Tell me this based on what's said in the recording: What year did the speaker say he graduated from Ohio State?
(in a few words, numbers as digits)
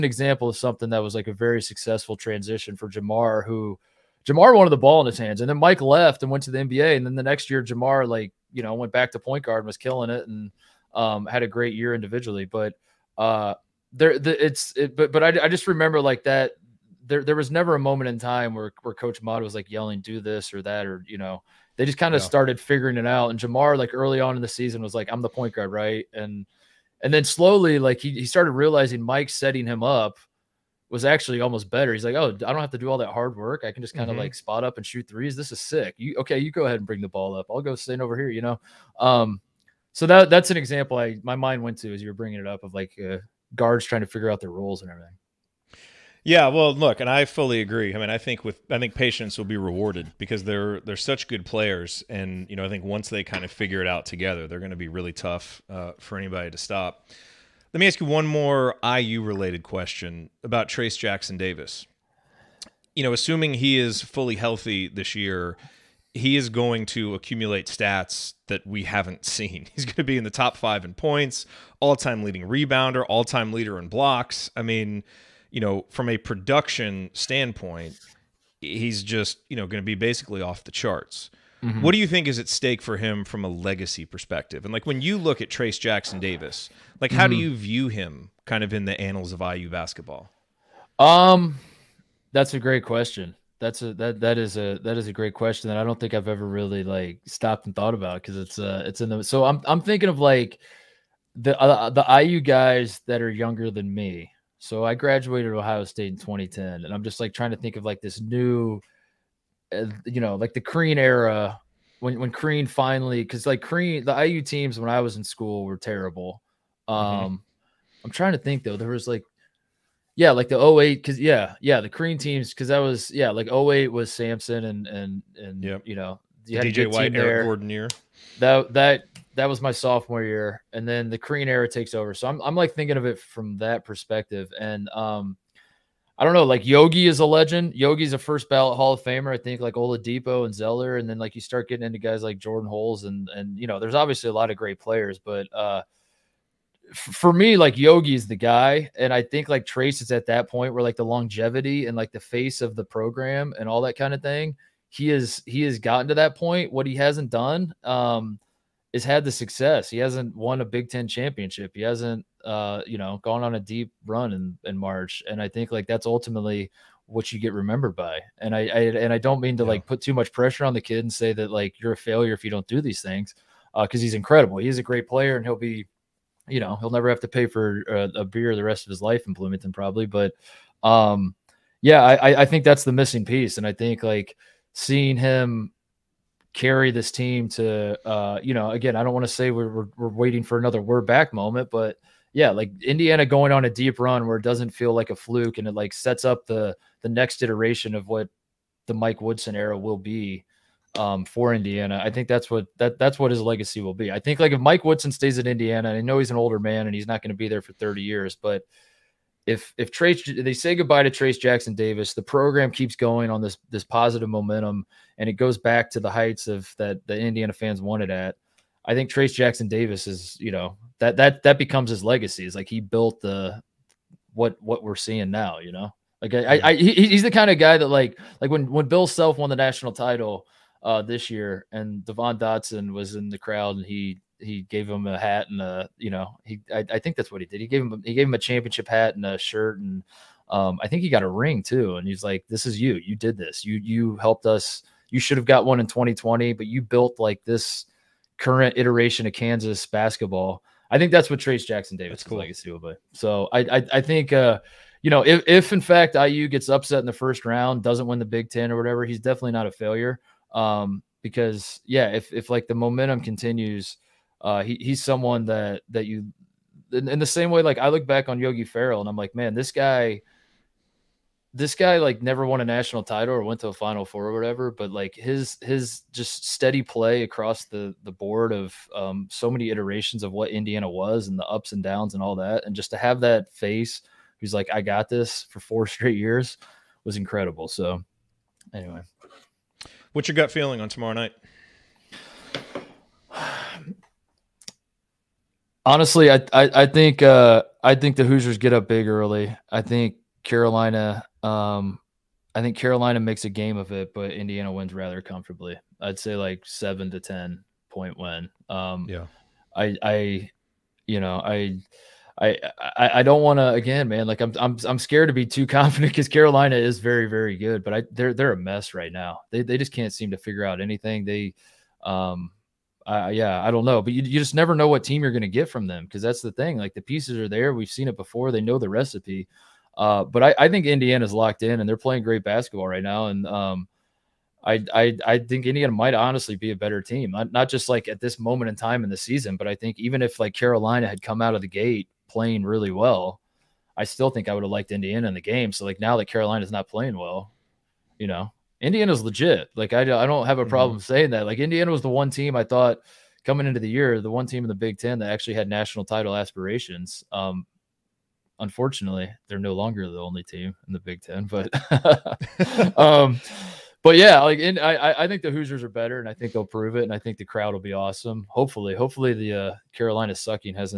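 2010.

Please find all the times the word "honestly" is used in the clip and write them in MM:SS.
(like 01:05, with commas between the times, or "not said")
04:55, 05:36.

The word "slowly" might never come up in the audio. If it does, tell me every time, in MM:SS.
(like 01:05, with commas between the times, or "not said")
00:27.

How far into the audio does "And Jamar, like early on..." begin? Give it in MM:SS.
00:23.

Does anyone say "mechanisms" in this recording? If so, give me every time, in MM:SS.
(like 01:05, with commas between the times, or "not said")
not said.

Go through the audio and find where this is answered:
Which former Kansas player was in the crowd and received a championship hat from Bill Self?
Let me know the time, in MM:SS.
03:52.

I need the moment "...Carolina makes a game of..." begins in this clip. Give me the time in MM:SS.
05:02.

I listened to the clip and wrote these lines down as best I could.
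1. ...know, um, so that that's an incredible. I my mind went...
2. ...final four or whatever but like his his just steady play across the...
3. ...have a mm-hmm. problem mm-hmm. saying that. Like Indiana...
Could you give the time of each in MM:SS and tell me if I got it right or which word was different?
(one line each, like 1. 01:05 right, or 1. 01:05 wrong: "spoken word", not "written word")
1. 00:38 wrong: "example", not "incredible"
2. 04:33 right
3. 05:50 right.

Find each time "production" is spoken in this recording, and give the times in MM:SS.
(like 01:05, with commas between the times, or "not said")
01:16.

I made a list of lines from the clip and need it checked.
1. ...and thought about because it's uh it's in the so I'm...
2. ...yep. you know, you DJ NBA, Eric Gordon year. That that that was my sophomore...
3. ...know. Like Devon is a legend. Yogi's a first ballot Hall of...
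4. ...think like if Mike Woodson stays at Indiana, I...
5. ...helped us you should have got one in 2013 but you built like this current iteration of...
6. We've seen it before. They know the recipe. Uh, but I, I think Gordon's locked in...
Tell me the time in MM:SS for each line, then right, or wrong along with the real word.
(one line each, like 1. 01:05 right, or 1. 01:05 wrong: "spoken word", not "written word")
1. 01:37 right
2. 02:05 wrong: "White", not "NBA"
3. 02:16 wrong: "Yogi", not "Devon"
4. 03:24 right
5. 04:04 wrong: "2020", not "2013"
6. 05:27 wrong: "Indiana", not "Gordon".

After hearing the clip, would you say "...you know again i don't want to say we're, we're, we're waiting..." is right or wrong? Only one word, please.
right.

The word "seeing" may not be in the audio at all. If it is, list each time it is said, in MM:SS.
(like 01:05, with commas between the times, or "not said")
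03:04, 03:44.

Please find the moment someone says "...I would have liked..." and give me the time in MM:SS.
05:44.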